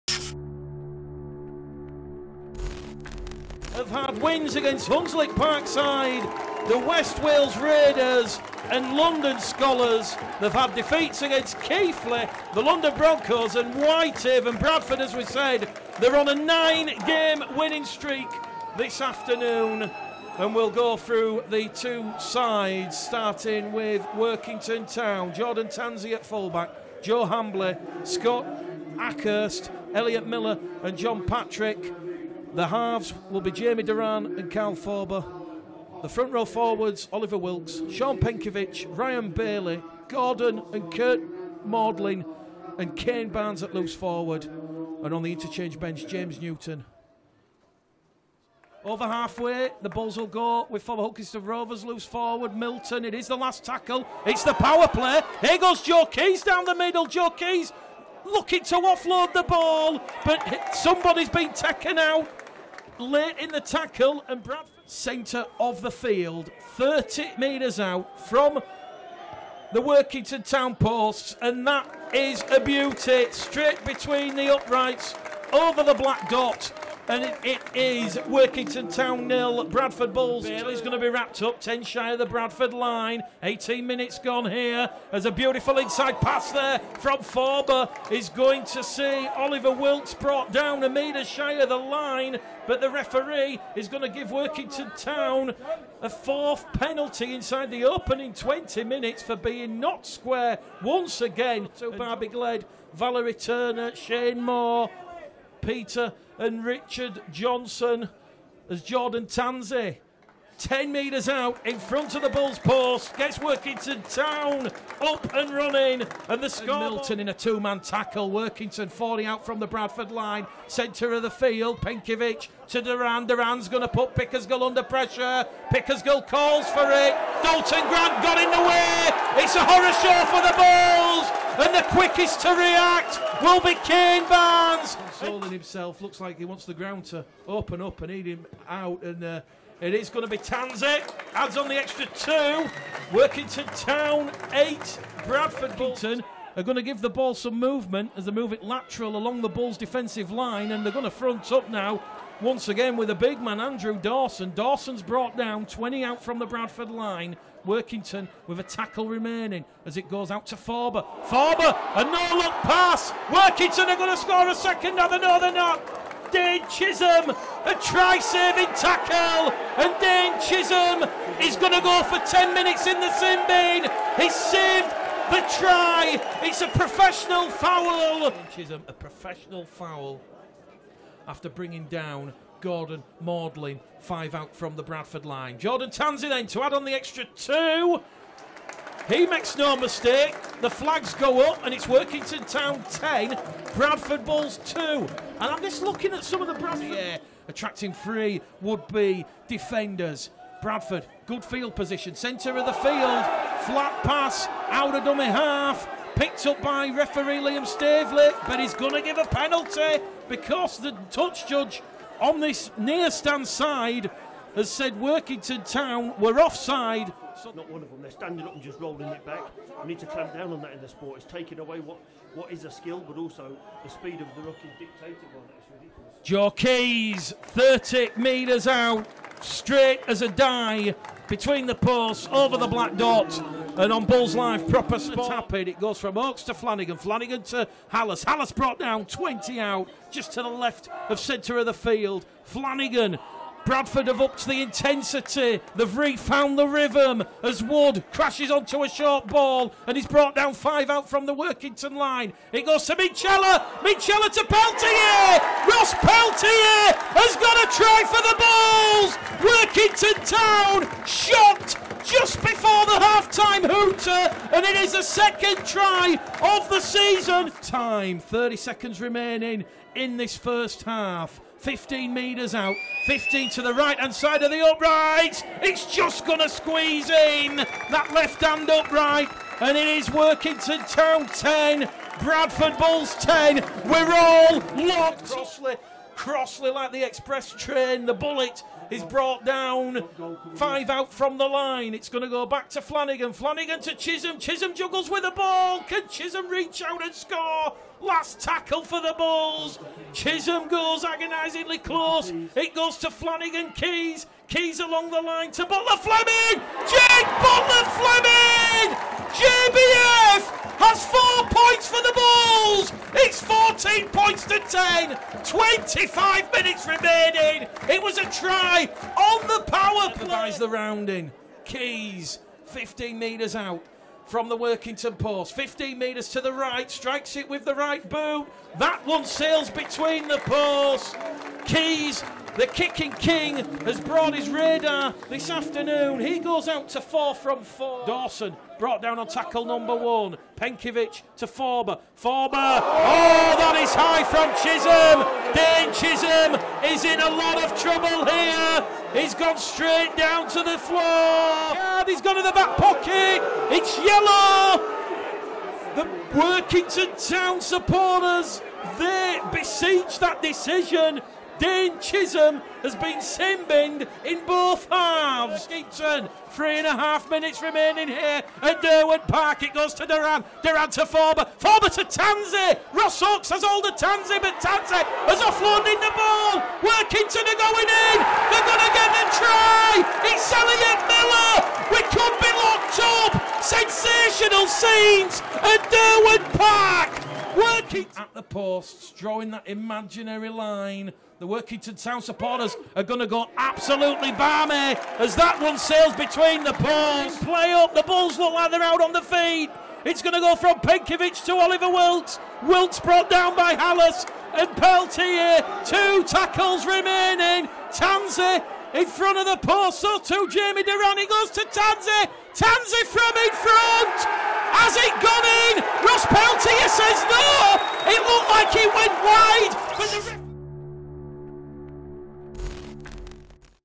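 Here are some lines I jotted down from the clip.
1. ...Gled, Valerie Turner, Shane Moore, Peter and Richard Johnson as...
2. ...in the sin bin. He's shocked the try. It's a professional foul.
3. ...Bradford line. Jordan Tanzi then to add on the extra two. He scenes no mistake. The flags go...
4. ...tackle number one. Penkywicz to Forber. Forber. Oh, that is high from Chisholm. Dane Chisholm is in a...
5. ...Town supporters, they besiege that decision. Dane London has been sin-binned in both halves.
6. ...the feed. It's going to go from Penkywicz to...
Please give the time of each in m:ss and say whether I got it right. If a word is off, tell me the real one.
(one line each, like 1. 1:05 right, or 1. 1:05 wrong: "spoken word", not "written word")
1. 1:42 right
2. 2:52 wrong: "saved", not "shocked"
3. 3:04 wrong: "makes", not "scenes"
4. 5:39 right
5. 5:57 wrong: "Chisholm", not "London"
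6. 6:39 right.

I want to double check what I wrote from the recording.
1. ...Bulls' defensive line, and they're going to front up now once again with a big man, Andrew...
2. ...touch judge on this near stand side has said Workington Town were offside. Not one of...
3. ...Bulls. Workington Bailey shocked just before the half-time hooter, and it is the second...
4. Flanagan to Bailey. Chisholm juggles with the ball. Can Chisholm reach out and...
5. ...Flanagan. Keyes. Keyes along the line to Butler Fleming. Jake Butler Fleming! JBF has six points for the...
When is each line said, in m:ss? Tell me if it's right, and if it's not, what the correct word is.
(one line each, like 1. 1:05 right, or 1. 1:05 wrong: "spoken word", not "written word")
1. 2:29 right
2. 3:31 right
3. 4:20 wrong: "Town", not "Bailey"
4. 4:53 wrong: "Chisholm", not "Bailey"
5. 5:03 wrong: "four", not "six".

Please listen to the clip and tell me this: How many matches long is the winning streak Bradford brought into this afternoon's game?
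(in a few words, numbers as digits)
9.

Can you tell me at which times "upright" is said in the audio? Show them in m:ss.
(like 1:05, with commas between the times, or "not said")
1:14, 4:34, 4:38.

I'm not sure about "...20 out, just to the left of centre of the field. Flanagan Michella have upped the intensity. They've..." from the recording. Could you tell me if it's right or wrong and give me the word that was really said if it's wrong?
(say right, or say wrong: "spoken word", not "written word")
wrong: "Bradford", not "Michella".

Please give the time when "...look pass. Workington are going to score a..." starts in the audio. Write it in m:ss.
2:42.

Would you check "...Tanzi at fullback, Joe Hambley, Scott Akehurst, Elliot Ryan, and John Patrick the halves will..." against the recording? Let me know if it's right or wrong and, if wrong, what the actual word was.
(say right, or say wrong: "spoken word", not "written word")
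wrong: "Miller", not "Ryan".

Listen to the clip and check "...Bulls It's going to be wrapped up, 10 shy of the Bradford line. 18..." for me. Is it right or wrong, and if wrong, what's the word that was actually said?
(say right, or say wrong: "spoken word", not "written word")
right.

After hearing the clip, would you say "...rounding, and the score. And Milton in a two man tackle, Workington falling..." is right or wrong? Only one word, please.
wrong.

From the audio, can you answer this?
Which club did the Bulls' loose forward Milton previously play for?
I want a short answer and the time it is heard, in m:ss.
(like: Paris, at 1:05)
Hull Kingston Rovers, at 0:51.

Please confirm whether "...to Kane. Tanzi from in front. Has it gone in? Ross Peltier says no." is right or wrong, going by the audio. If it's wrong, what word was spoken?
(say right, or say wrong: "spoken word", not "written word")
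wrong: "Tanzi", not "Kane".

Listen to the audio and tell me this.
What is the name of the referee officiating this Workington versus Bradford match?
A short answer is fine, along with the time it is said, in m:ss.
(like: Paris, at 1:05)
Liam Staveley, at 3:27.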